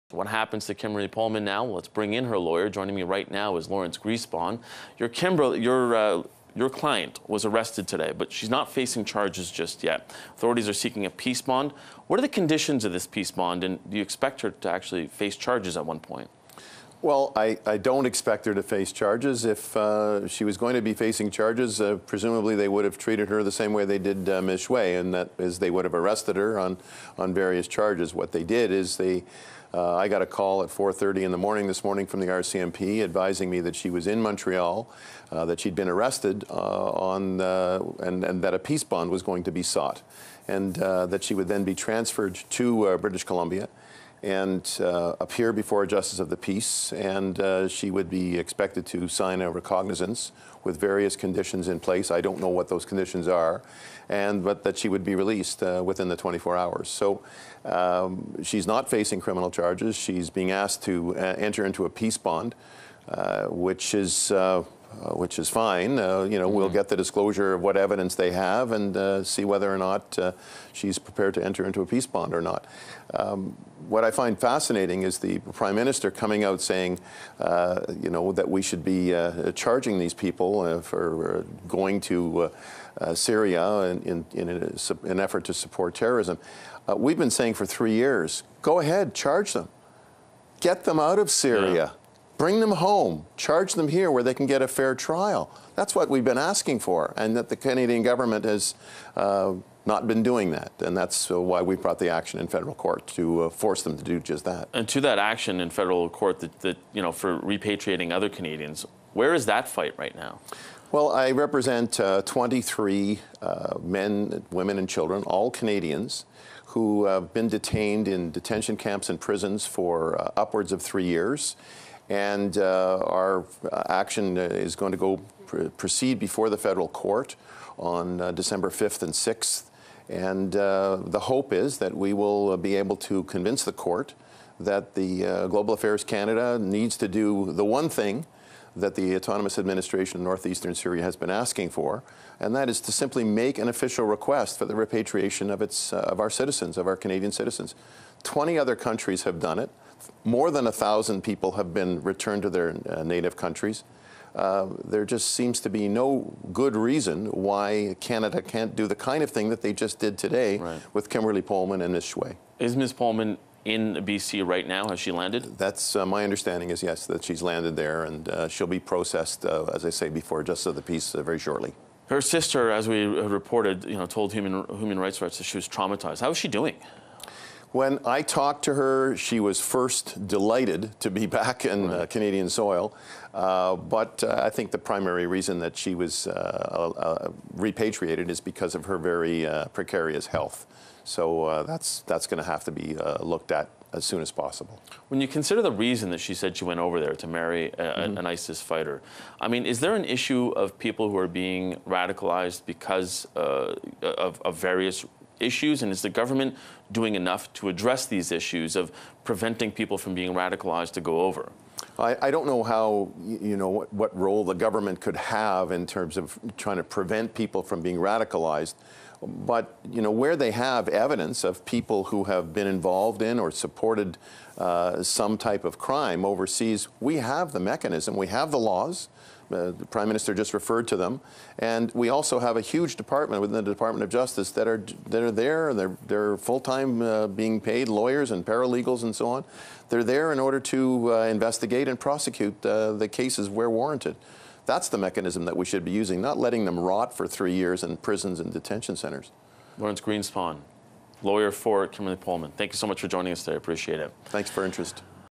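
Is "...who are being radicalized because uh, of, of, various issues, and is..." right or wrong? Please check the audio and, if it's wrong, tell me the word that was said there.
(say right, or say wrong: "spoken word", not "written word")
right.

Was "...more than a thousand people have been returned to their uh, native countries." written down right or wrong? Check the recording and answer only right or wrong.
right.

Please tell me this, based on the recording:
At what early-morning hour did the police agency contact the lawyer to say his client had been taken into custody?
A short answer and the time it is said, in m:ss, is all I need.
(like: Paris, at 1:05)
4:30, at 0:30.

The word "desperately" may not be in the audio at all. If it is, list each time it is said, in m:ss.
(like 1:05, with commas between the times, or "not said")
not said.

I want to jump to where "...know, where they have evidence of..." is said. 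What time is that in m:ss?
3:40.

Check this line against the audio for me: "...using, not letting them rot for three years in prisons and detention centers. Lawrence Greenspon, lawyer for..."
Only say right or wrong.
right.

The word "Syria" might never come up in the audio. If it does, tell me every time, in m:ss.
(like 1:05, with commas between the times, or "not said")
1:23, 1:31, 2:20.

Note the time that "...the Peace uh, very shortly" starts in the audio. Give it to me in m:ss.
2:50.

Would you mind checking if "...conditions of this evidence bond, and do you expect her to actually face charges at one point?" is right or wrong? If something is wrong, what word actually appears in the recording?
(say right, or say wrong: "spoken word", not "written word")
wrong: "peace", not "evidence".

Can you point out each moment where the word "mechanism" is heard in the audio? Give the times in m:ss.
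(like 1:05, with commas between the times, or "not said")
3:47, 4:04.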